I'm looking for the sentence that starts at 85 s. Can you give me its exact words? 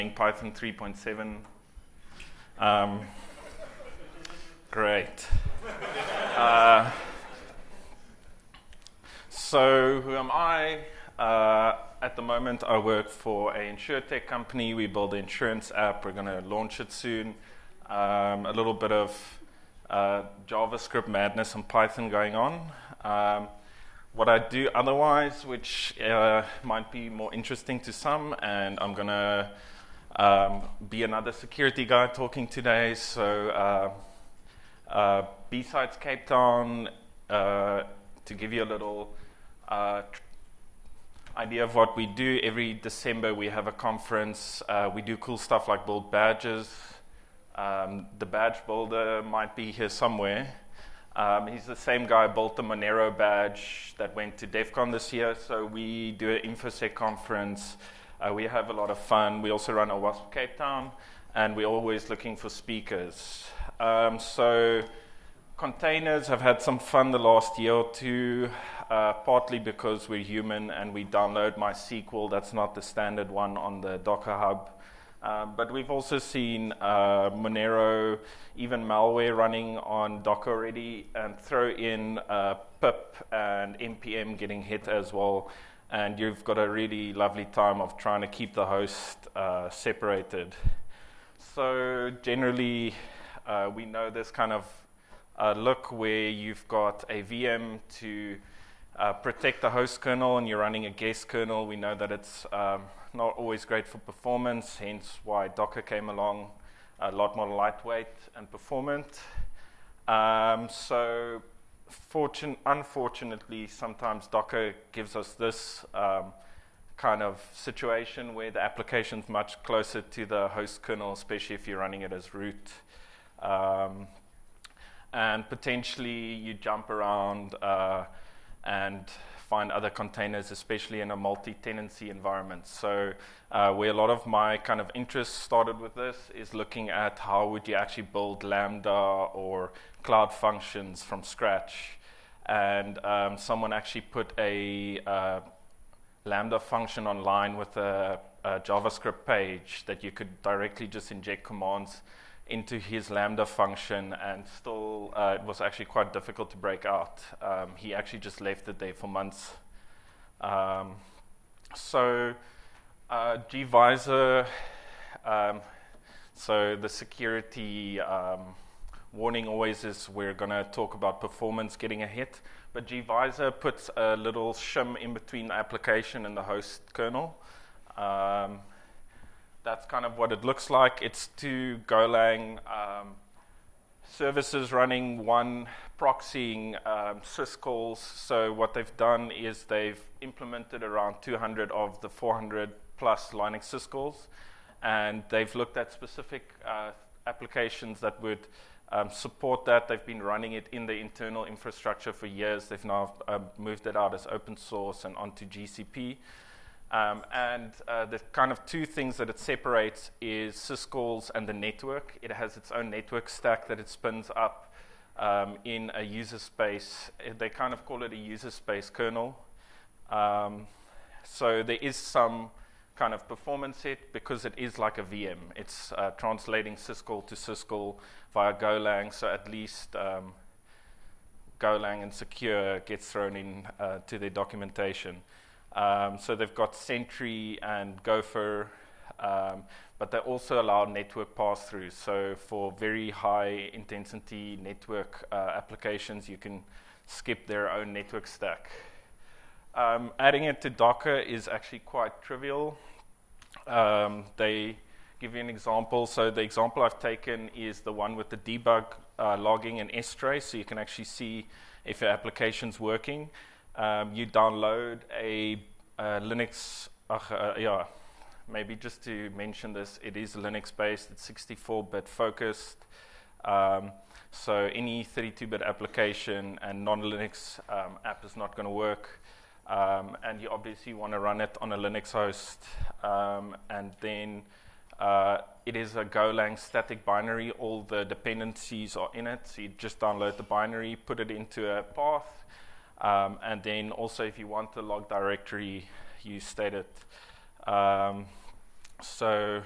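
And you've got a really lovely time of trying to keep the host uh, separated.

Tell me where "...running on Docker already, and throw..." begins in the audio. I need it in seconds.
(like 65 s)
79 s.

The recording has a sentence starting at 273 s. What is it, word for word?
Um, so any 32 bit application and non Linux um, app is not going to work.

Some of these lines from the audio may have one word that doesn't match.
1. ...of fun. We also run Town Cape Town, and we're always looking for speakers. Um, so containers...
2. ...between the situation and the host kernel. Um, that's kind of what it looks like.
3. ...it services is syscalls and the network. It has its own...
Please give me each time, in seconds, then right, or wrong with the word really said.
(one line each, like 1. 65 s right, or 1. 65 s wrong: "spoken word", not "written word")
1. 58 s wrong: "OWASP", not "Town"
2. 175 s wrong: "application", not "situation"
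3. 209 s wrong: "separates", not "services".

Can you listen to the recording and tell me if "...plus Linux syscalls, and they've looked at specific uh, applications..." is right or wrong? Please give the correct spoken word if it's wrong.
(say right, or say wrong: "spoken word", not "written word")
right.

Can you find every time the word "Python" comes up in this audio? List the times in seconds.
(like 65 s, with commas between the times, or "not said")
0 s, 21 s.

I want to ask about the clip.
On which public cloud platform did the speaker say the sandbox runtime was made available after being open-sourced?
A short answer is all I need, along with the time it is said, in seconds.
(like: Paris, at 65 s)
GCP, at 205 s.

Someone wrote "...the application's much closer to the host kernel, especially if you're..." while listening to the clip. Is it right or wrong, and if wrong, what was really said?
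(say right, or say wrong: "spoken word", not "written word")
right.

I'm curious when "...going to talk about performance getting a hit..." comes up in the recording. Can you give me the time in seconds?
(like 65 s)
170 s.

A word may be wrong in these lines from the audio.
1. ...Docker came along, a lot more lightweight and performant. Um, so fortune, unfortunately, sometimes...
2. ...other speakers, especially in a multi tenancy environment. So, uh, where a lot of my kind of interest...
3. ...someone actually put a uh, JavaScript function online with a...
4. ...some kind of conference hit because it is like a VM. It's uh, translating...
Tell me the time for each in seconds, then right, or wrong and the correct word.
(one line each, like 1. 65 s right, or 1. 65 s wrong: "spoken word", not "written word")
1. 105 s right
2. 129 s wrong: "containers", not "speakers"
3. 143 s wrong: "Lambda", not "JavaScript"
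4. 221 s wrong: "performance", not "conference".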